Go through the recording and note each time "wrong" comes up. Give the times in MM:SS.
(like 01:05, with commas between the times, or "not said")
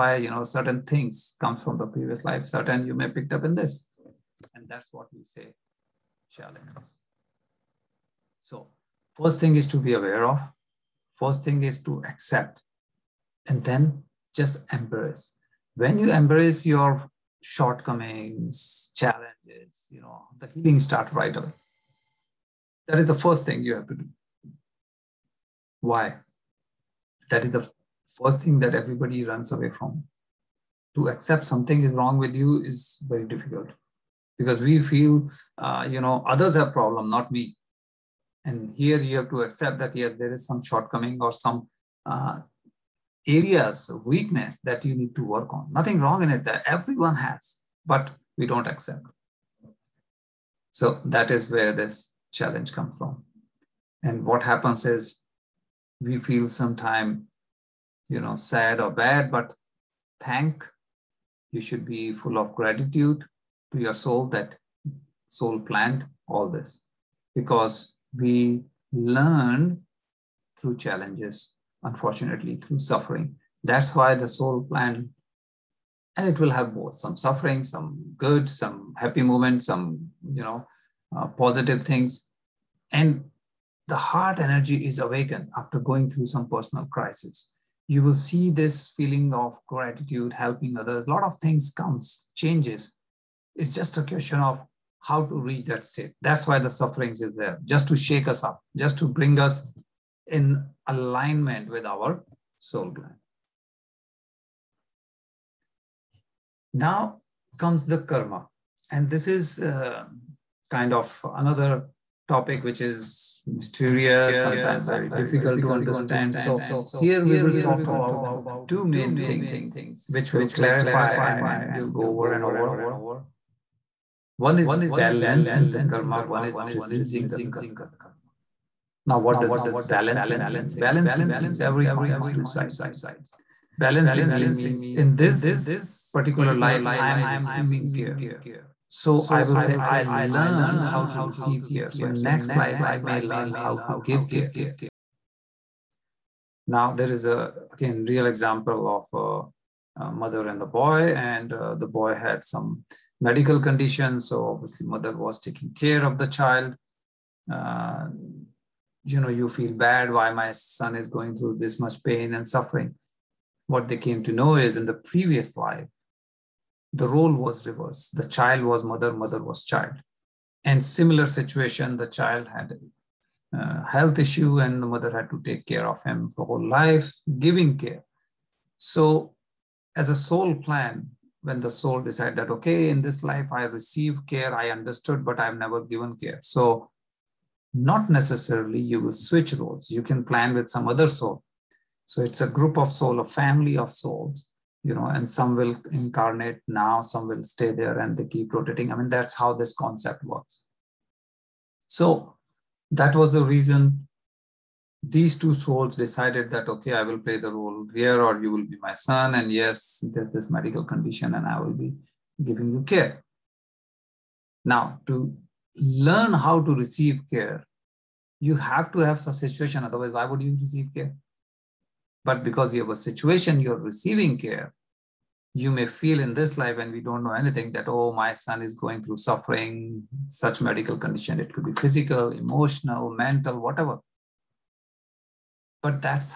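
00:31, 00:45.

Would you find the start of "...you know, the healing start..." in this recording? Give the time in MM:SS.
00:19.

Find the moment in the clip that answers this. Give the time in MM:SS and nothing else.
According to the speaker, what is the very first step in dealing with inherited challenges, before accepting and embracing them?
00:09.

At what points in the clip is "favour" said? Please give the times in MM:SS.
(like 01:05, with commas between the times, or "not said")
not said.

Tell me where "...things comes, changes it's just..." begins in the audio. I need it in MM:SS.
01:31.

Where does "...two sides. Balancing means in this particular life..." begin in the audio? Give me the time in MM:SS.
02:12.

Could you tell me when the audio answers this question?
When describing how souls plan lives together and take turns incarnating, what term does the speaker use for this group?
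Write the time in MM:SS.
03:13.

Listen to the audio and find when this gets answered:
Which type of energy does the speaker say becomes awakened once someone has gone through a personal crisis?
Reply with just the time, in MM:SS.
01:23.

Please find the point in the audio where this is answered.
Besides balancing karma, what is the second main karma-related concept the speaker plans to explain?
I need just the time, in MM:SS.
02:06.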